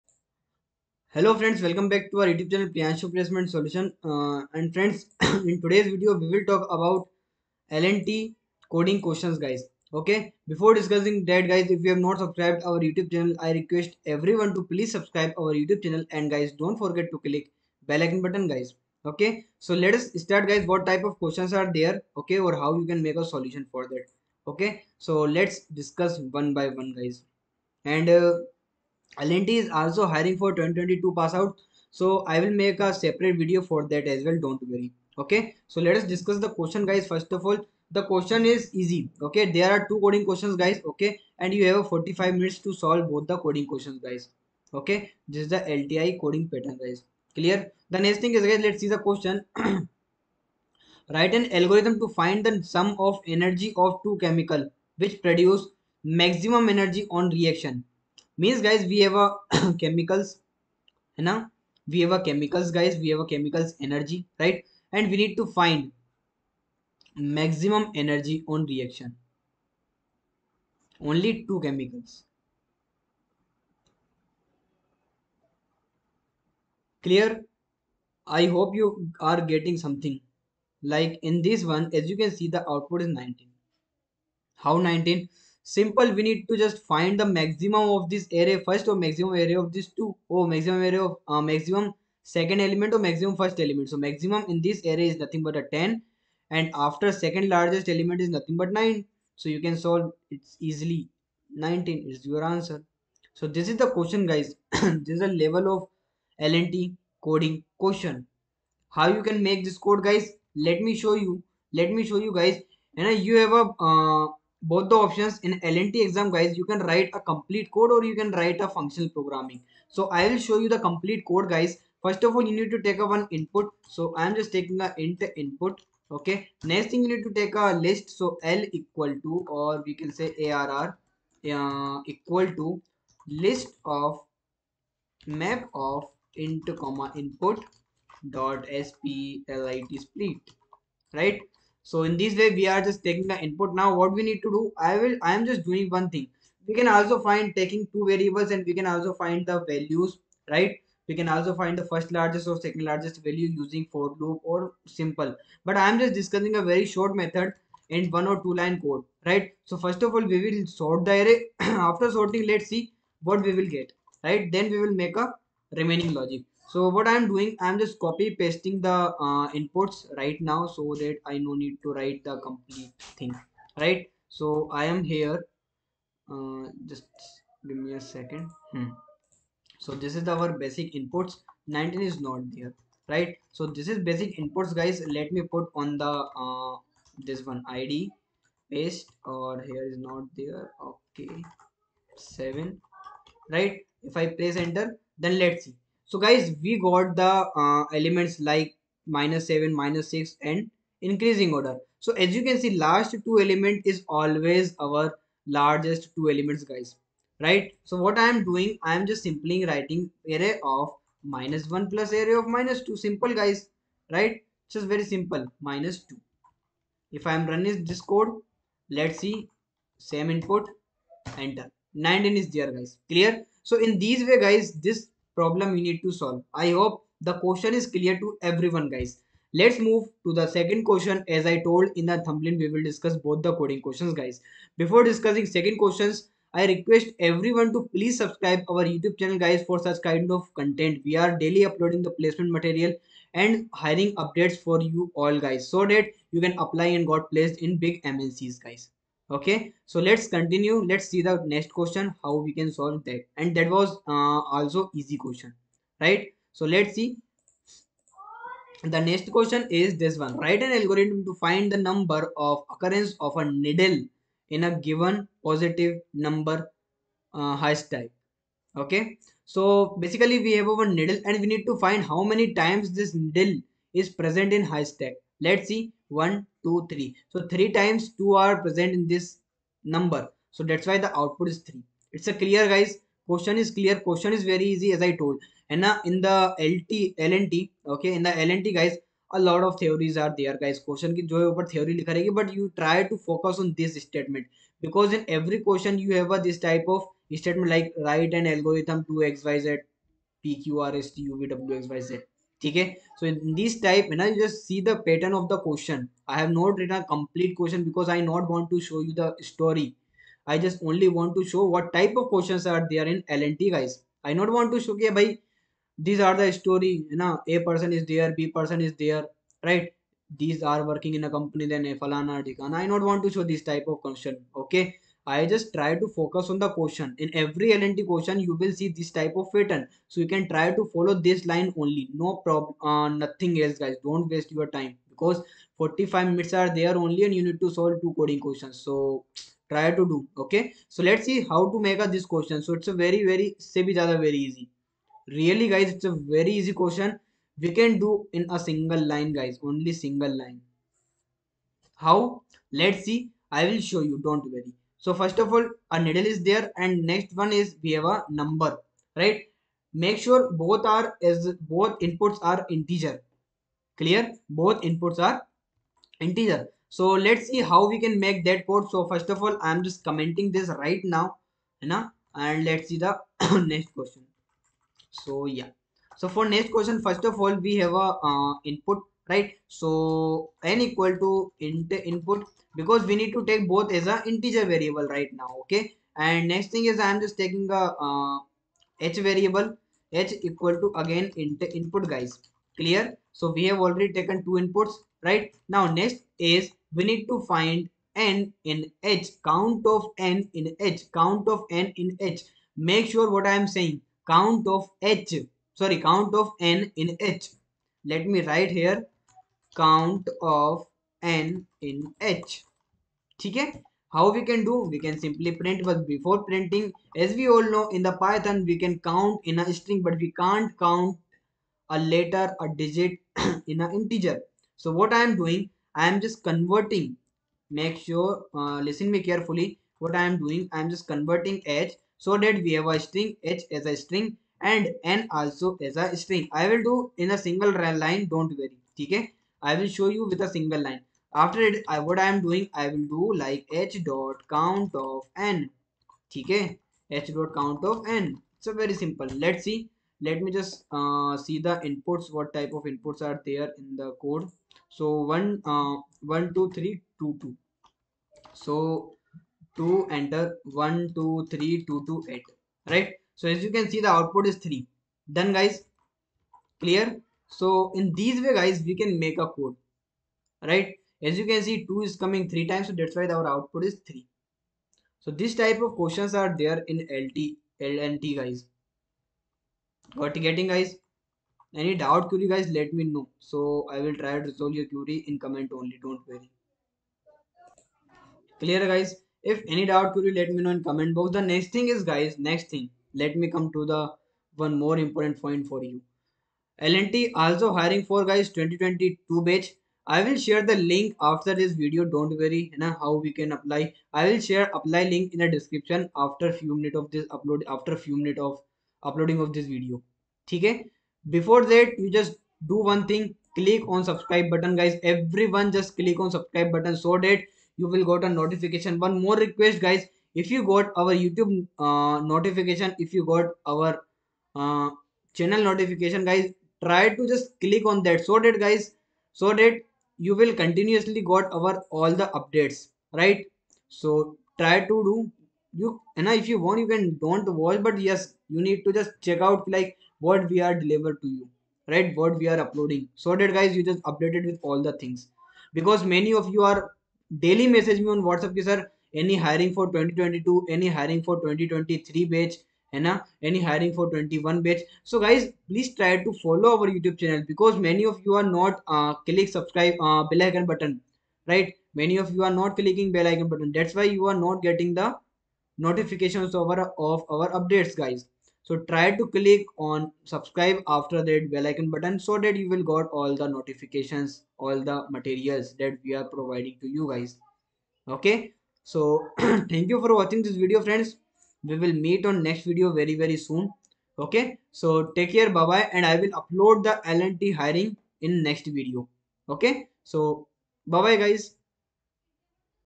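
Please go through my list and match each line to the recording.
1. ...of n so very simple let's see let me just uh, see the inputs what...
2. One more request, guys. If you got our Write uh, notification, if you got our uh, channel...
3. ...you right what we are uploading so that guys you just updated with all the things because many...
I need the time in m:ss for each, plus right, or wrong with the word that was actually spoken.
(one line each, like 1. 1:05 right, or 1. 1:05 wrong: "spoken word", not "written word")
1. 7:27 right
2. 8:38 wrong: "YouTube", not "Write"
3. 9:01 right.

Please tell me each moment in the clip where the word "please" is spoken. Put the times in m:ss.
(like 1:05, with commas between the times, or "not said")
0:14, 3:57, 9:15.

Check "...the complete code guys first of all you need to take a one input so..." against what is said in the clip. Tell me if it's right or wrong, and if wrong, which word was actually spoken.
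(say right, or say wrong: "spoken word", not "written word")
right.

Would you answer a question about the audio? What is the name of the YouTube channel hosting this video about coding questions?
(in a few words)
Priyanshu placement solution.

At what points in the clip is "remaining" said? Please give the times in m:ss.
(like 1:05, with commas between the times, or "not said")
2:45.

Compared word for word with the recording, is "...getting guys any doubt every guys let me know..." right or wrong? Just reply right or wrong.
wrong.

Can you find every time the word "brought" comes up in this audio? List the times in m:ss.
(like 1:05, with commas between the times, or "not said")
not said.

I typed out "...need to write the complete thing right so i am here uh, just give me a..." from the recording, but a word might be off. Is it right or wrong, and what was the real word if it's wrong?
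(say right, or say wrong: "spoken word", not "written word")
right.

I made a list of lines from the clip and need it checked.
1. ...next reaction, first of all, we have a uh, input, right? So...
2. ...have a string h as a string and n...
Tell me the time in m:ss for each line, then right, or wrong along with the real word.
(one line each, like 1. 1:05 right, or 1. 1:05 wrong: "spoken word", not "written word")
1. 6:16 wrong: "question", not "reaction"
2. 7:12 right.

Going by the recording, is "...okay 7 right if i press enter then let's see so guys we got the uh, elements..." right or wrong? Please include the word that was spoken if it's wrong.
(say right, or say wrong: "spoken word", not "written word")
right.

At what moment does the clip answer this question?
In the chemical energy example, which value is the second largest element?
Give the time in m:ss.
1:38.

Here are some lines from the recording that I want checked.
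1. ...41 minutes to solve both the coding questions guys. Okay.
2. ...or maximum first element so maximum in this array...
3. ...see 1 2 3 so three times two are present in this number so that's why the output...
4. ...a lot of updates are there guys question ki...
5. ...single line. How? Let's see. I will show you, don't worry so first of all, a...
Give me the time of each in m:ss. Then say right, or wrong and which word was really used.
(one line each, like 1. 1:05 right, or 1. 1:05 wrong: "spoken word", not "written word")
1. 0:41 wrong: "45", not "41"
2. 1:32 right
3. 4:35 right
4. 4:49 wrong: "theories", not "updates"
5. 5:49 right.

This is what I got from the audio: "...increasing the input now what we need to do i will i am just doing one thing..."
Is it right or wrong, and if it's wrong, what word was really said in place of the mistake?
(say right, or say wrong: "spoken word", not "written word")
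wrong: "taking", not "increasing".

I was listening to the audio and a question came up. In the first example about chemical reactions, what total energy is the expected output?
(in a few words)
19.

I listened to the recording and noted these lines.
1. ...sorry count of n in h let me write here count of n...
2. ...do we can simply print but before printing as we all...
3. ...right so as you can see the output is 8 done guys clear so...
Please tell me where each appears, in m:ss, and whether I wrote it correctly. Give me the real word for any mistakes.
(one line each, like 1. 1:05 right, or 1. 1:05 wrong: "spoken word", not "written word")
1. 6:45 right
2. 6:54 right
3. 7:42 wrong: "3", not "8".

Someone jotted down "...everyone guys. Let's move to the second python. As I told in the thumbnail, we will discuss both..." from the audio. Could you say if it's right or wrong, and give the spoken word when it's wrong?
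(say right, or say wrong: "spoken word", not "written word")
wrong: "question", not "python".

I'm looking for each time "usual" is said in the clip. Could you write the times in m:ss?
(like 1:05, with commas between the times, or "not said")
not said.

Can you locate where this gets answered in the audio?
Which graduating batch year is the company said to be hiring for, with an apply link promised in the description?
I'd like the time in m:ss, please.
8:18.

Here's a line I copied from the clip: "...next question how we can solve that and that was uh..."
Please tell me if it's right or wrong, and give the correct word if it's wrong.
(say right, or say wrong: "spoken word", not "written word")
right.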